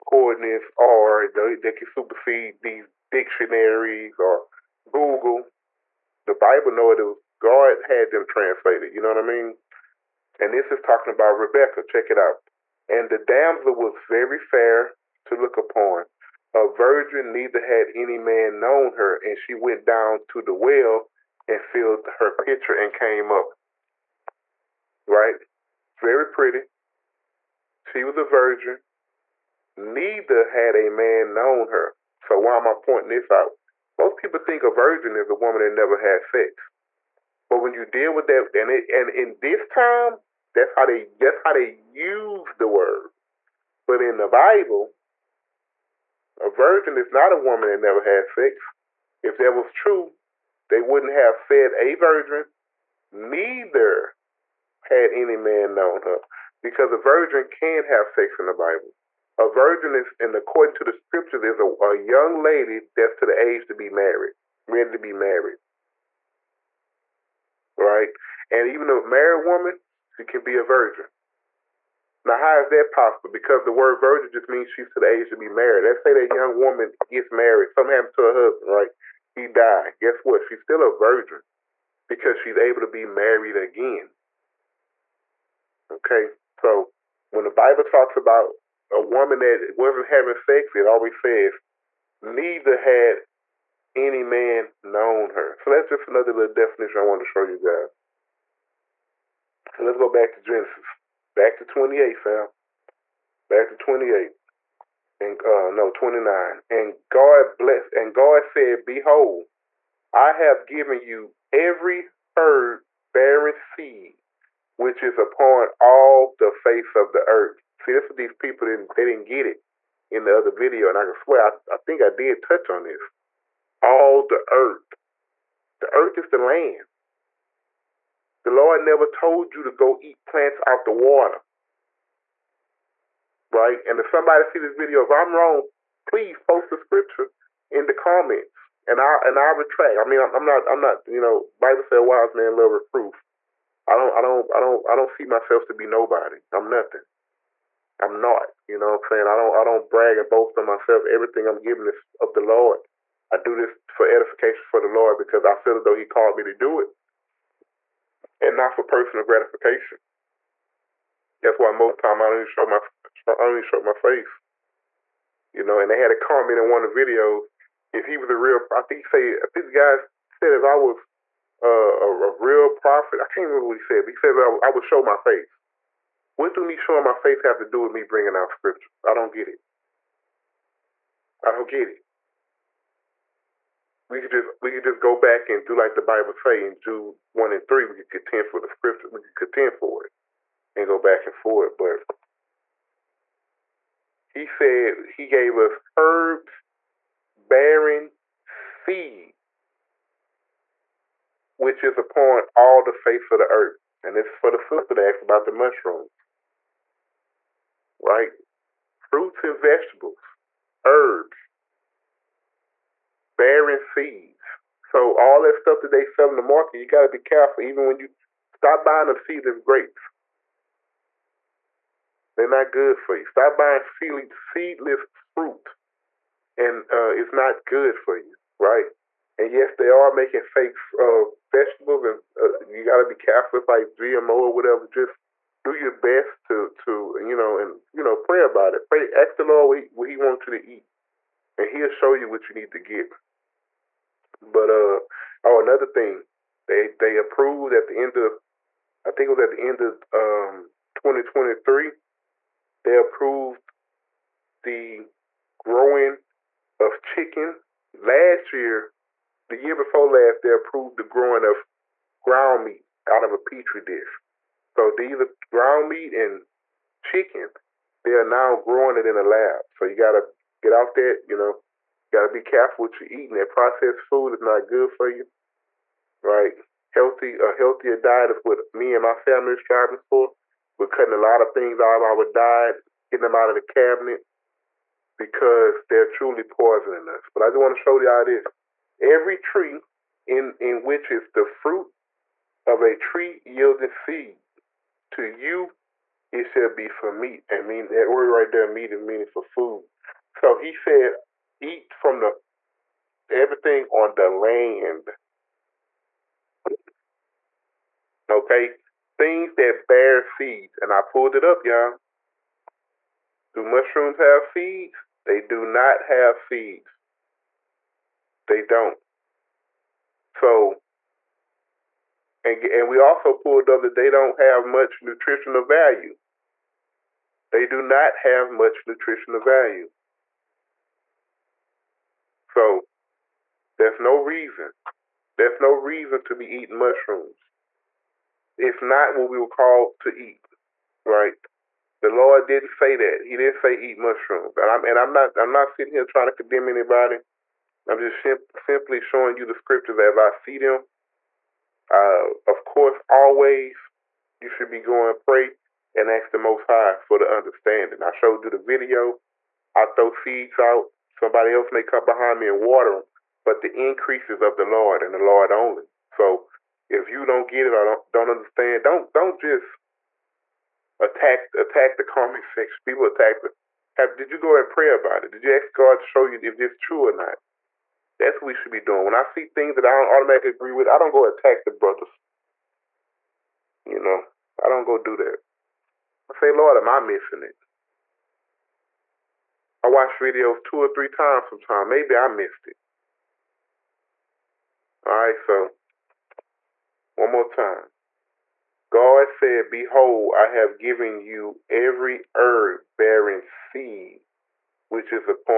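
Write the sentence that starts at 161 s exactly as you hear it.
That's why most time I don't even show my I don't even show my face.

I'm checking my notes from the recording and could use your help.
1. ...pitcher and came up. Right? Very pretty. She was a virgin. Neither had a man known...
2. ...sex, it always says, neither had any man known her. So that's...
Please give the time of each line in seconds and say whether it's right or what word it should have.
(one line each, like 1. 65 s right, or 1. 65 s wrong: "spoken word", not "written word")
1. 22 s right
2. 90 s right.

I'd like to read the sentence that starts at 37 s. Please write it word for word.
But when you deal with that, and it, and in this time, that's how they that's how they use the word.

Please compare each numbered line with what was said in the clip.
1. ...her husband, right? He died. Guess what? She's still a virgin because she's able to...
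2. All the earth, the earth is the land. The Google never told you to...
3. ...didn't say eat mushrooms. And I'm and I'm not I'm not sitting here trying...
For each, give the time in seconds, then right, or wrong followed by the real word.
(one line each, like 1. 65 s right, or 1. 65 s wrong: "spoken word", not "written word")
1. 78 s right
2. 123 s wrong: "Lord", not "Google"
3. 343 s right.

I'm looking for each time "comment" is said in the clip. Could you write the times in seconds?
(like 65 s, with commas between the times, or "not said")
137 s, 166 s, 372 s.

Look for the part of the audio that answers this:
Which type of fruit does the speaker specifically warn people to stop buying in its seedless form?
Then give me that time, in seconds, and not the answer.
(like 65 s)
219 s.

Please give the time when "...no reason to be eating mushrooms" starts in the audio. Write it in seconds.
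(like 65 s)
335 s.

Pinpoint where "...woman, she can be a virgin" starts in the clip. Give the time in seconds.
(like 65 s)
69 s.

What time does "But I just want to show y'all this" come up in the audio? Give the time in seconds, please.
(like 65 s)
287 s.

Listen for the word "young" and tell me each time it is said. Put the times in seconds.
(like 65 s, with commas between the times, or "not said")
61 s, 76 s.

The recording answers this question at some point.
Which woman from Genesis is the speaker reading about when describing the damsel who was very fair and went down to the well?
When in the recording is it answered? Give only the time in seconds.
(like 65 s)
11 s.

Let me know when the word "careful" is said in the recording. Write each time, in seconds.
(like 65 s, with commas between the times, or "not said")
217 s, 233 s, 272 s.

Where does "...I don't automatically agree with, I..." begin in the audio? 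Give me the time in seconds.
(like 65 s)
379 s.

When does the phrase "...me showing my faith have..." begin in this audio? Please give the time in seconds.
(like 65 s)
176 s.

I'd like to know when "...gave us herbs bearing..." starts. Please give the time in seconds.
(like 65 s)
195 s.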